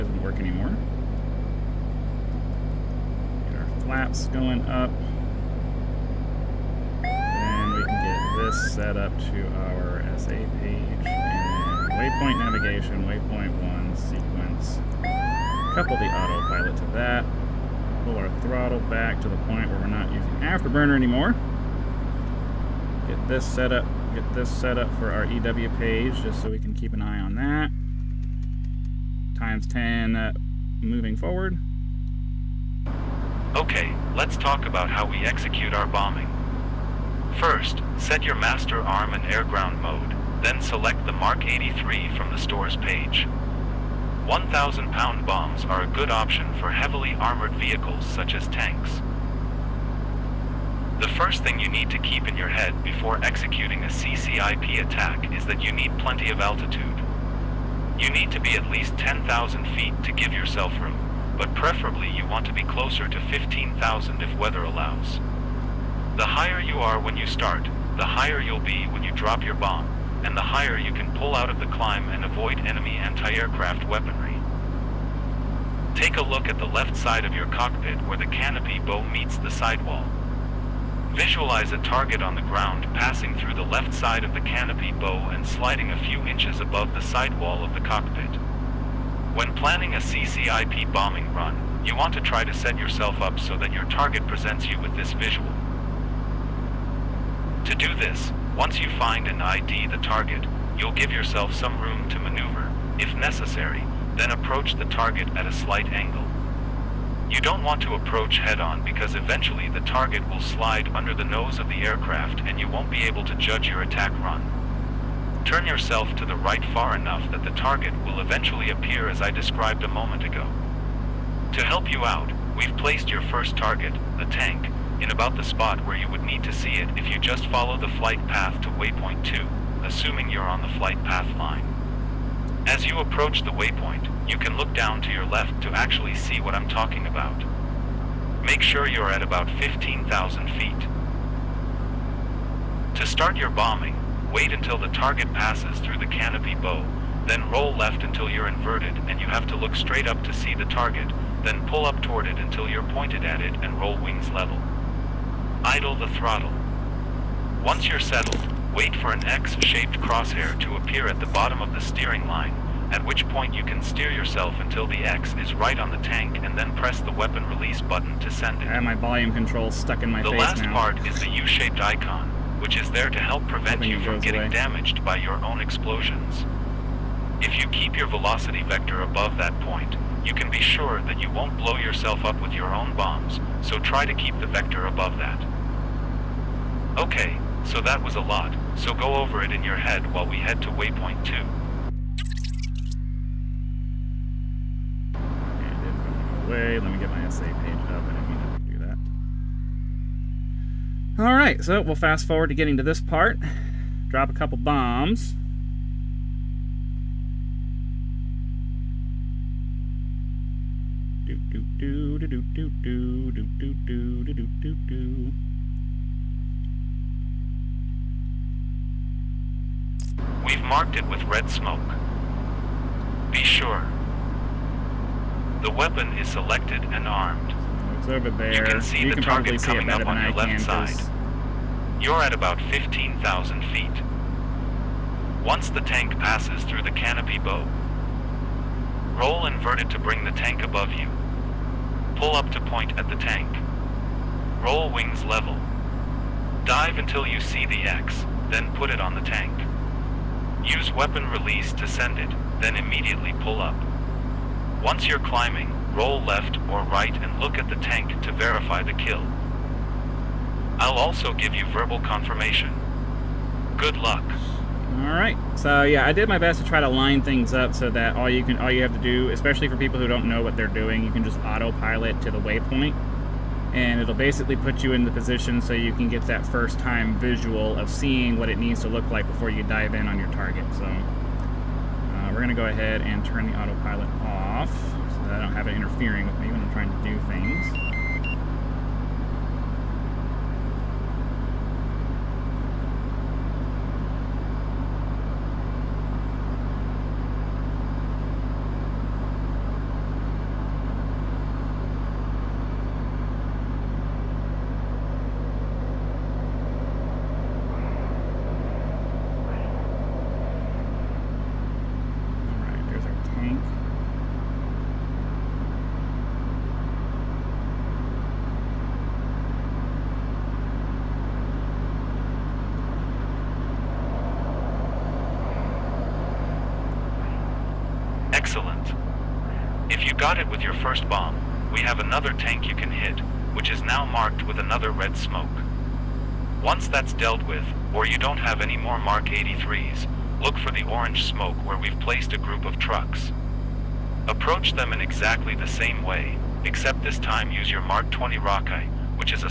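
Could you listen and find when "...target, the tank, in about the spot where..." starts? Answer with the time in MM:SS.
02:03.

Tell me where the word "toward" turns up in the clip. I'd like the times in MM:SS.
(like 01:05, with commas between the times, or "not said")
02:32.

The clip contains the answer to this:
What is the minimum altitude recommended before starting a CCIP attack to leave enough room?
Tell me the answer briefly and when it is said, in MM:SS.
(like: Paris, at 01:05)
10,000 feet, at 00:58.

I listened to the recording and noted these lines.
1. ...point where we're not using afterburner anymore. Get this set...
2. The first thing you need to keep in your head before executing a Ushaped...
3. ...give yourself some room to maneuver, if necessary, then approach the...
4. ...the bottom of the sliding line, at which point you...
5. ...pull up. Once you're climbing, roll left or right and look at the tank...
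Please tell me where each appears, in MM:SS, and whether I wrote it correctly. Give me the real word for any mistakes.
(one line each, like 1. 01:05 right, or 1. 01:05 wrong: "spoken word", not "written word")
1. 00:19 right
2. 00:50 wrong: "CCIP", not "Ushaped"
3. 01:40 right
4. 02:41 wrong: "steering", not "sliding"
5. 04:13 right.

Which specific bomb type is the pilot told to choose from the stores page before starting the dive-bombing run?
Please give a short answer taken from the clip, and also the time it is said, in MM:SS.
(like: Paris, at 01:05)
Mark 83, at 00:41.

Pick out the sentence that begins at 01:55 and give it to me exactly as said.
Turn yourself to the right far enough that the target will eventually appear as I described a moment ago.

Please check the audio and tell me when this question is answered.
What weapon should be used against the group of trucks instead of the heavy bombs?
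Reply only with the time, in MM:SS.
05:47.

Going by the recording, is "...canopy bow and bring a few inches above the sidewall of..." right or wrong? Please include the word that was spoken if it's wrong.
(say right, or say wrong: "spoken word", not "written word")
wrong: "sliding", not "bring".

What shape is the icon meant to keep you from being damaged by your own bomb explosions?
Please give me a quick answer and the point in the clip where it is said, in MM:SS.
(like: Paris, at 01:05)
U-shaped, at 02:51.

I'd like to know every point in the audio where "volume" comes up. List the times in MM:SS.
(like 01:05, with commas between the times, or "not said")
02:48.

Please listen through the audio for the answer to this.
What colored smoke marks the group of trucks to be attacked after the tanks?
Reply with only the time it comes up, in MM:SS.
05:40.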